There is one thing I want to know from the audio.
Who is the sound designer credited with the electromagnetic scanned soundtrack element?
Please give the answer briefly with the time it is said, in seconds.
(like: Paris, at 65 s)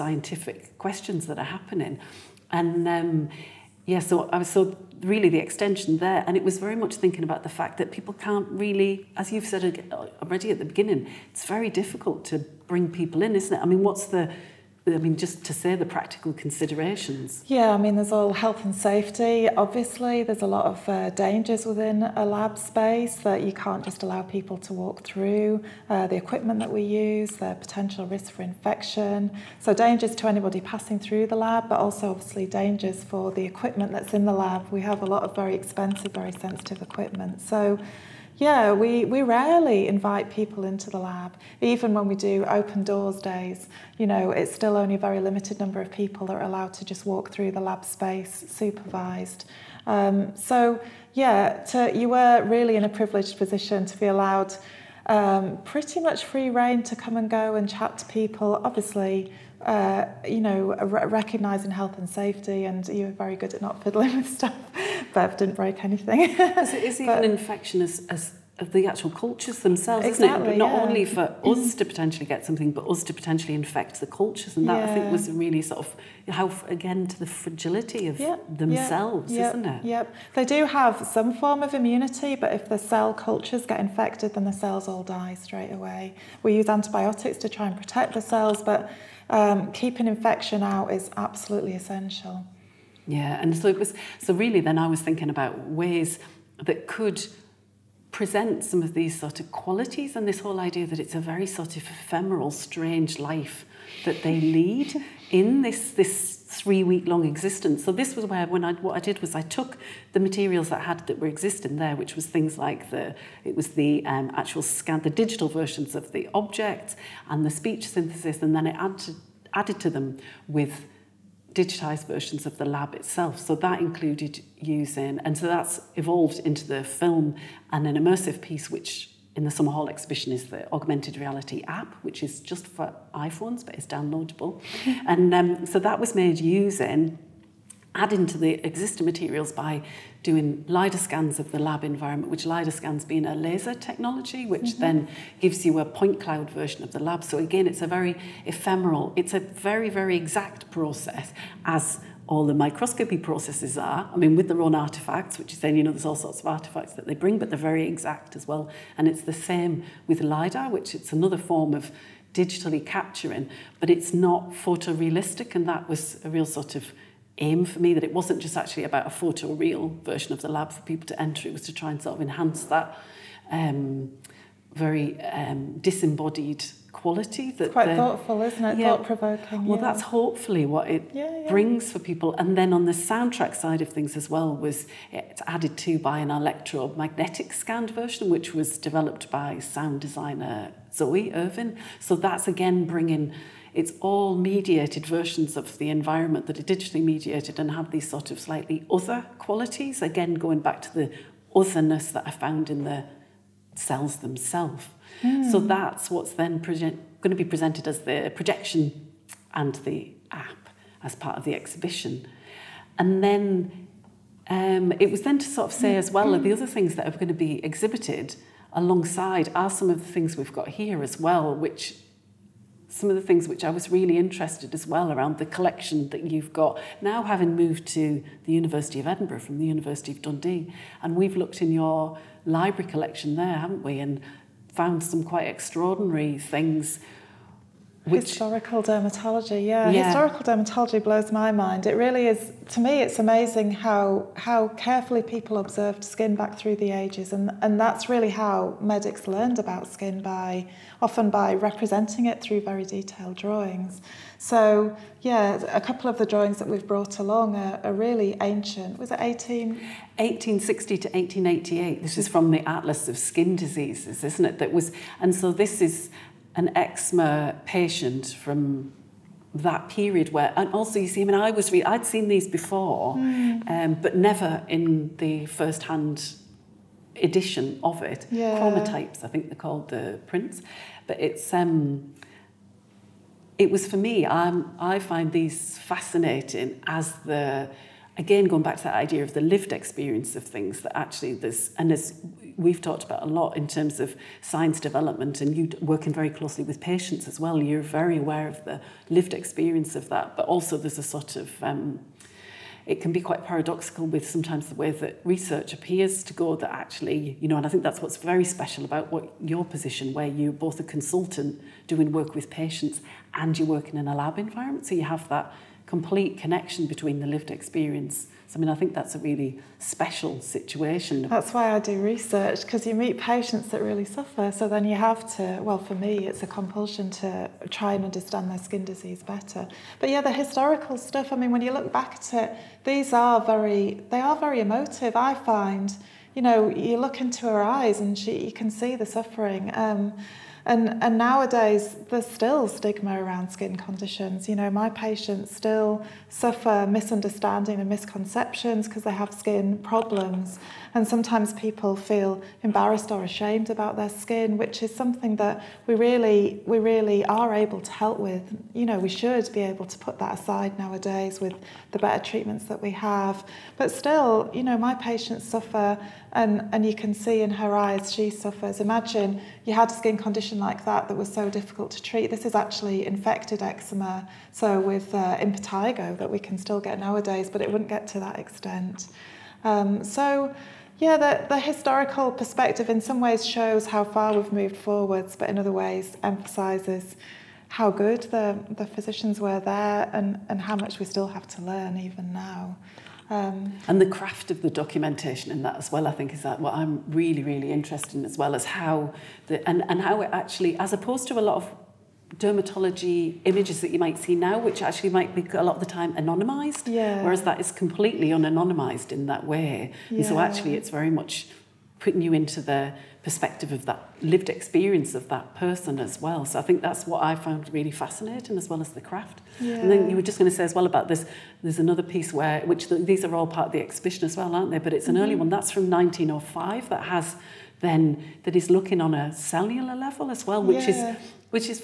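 Zoe Irvin, at 190 s.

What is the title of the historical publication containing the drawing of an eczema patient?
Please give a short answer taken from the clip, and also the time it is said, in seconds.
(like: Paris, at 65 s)
Atlas of Skin Diseases, at 262 s.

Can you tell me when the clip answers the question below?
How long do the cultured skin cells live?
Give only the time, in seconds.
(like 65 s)
106 s.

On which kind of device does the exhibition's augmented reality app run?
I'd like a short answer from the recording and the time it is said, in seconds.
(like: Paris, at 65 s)
iPhones, at 133 s.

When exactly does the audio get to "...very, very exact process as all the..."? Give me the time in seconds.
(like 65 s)
149 s.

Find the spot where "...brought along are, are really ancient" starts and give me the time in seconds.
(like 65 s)
256 s.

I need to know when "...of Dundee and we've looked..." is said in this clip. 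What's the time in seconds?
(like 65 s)
230 s.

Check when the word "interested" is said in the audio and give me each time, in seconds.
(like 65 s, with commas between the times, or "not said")
224 s, 397 s.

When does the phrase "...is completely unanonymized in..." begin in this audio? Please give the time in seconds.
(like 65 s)
407 s.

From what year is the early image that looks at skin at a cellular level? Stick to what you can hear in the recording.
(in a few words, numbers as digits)
1905.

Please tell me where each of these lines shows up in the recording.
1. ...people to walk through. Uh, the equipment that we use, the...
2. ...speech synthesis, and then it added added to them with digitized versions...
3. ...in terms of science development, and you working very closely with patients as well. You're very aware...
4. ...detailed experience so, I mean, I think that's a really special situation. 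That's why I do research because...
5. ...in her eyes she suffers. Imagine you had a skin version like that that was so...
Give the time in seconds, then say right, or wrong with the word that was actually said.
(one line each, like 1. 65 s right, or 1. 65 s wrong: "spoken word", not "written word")
1. 24 s right
2. 117 s right
3. 293 s right
4. 317 s wrong: "lived", not "detailed"
5. 367 s wrong: "condition", not "version".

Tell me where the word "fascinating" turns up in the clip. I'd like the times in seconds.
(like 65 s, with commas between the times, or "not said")
285 s, 417 s.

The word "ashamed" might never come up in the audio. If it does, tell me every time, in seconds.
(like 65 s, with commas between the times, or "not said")
353 s.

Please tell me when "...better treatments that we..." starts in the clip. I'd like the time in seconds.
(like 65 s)
361 s.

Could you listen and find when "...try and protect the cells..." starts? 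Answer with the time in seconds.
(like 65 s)
87 s.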